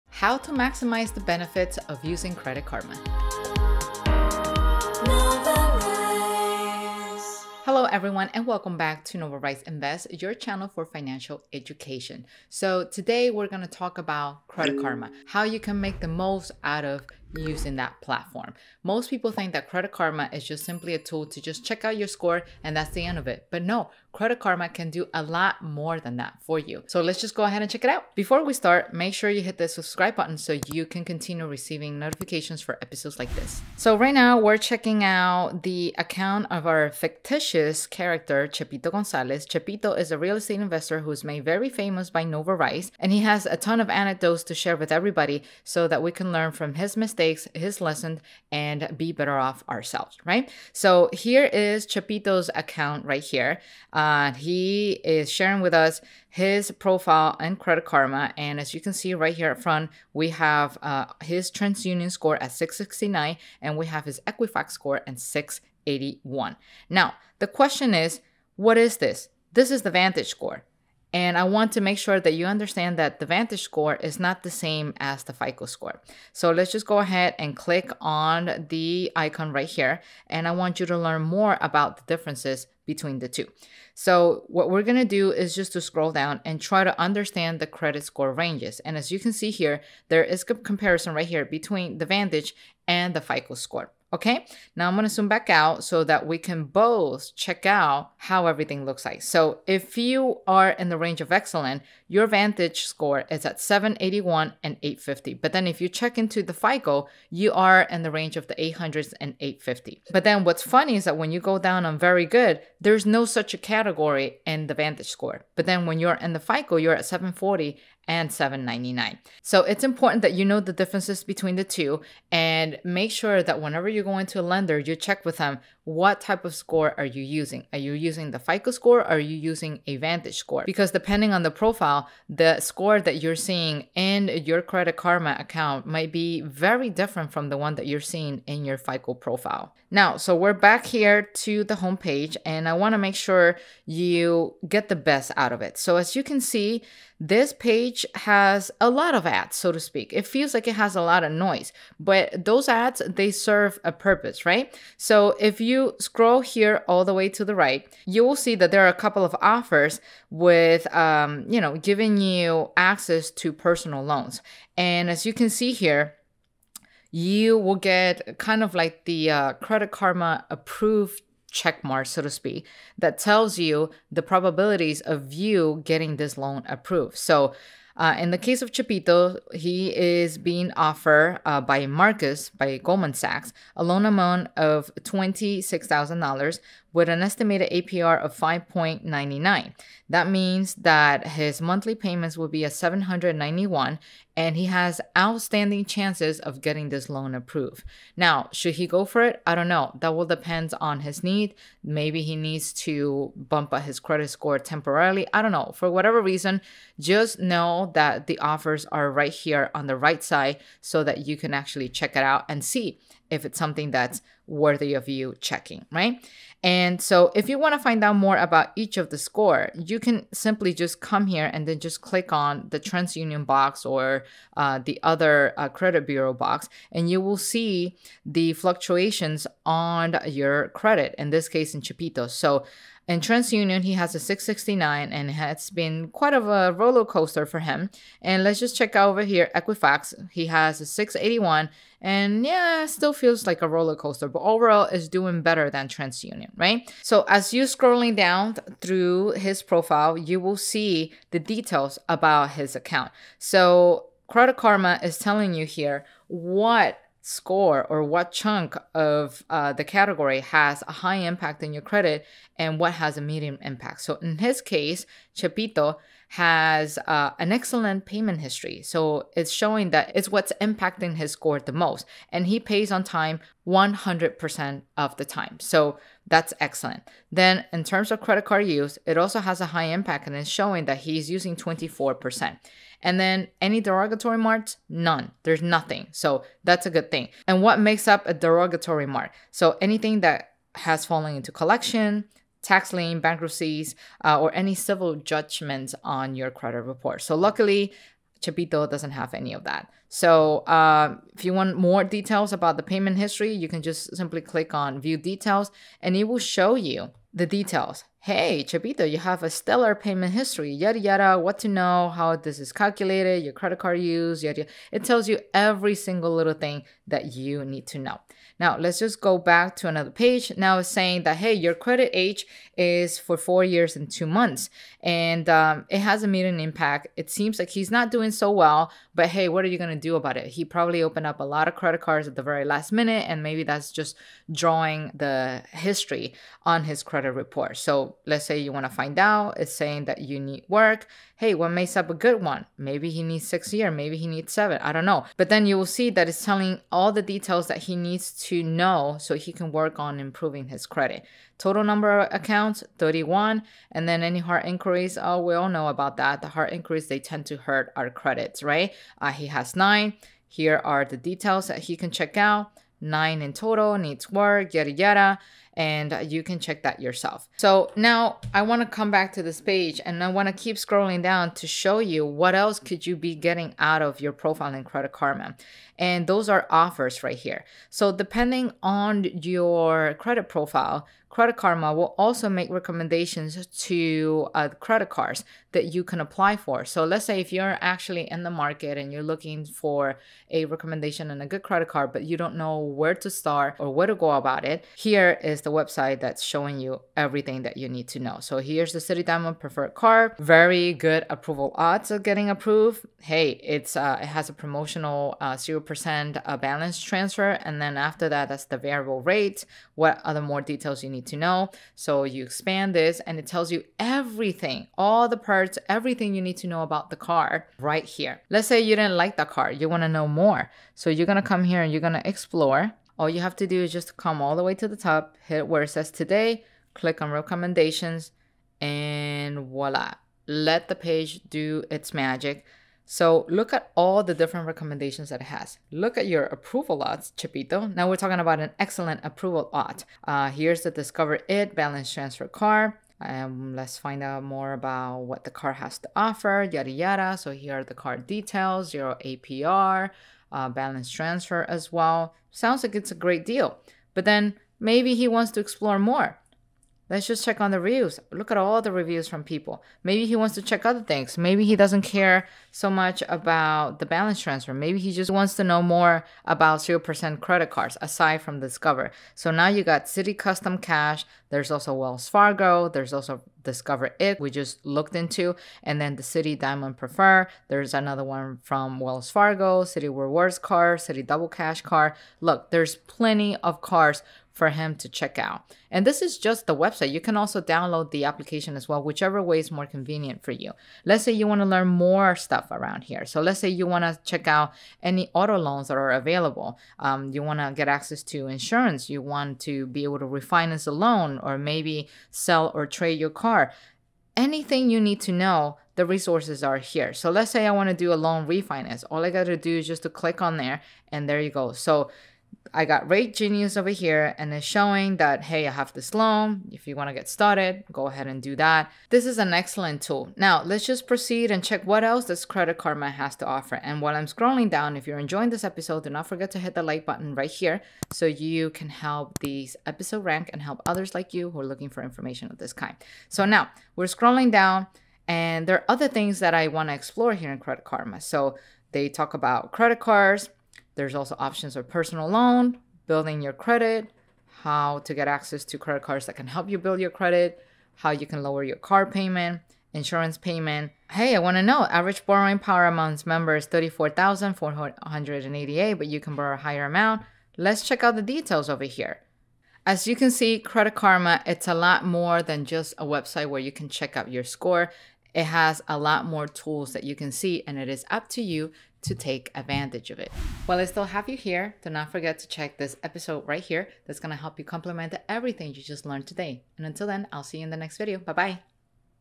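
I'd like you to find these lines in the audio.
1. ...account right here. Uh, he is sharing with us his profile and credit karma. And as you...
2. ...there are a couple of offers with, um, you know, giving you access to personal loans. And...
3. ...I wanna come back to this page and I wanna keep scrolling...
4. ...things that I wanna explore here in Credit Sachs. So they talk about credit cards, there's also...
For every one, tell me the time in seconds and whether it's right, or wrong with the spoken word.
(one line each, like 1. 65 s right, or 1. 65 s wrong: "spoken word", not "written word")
1. 52 s right
2. 158 s right
3. 368 s right
4. 536 s wrong: "Karma", not "Sachs".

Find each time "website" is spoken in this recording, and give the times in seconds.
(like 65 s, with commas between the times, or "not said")
395 s, 486 s, 563 s.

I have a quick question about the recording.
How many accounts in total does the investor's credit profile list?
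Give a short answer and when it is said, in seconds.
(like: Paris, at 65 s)
31, at 352 s.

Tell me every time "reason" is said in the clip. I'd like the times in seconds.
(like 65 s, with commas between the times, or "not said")
206 s.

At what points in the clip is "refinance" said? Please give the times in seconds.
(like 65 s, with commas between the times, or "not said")
500 s, 508 s.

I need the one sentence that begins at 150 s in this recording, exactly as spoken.
It feels like it has a lot of noise, but those ads, they serve a purpose, right?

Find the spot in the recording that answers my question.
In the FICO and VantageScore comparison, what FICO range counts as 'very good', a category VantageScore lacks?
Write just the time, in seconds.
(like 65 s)
117 s.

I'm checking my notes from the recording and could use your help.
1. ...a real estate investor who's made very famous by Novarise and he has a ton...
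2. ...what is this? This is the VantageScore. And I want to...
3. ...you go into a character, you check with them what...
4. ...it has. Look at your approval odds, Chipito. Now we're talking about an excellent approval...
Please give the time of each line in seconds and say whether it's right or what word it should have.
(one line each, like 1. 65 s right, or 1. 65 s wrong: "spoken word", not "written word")
1. 40 s right
2. 68 s right
3. 123 s wrong: "lender", not "character"
4. 435 s right.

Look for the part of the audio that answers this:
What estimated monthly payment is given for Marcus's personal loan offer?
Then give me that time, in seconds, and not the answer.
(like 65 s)
192 s.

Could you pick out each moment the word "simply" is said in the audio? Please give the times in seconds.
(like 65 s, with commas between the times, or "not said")
20 s, 220 s, 304 s.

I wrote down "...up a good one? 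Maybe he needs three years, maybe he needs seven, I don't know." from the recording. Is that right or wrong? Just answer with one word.
wrong.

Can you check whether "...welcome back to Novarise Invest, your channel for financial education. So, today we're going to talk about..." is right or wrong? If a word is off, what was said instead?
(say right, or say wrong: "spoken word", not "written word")
right.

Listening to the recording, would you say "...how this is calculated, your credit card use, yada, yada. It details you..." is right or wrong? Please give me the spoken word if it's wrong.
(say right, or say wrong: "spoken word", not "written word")
wrong: "tells", not "details".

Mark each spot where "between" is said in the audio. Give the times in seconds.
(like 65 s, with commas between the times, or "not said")
82 s, 91 s, 121 s.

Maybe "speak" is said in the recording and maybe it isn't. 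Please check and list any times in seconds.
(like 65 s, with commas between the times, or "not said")
149 s, 172 s.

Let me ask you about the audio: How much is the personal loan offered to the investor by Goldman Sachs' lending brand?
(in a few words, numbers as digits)
$26,000.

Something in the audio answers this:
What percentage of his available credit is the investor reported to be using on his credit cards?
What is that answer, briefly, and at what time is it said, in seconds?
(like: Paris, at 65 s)
24%, at 281 s.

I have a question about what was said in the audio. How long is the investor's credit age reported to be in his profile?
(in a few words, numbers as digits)
4 years and 2 months.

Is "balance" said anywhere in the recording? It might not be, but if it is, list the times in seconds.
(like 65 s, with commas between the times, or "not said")
406 s, 441 s, 450 s, 464 s.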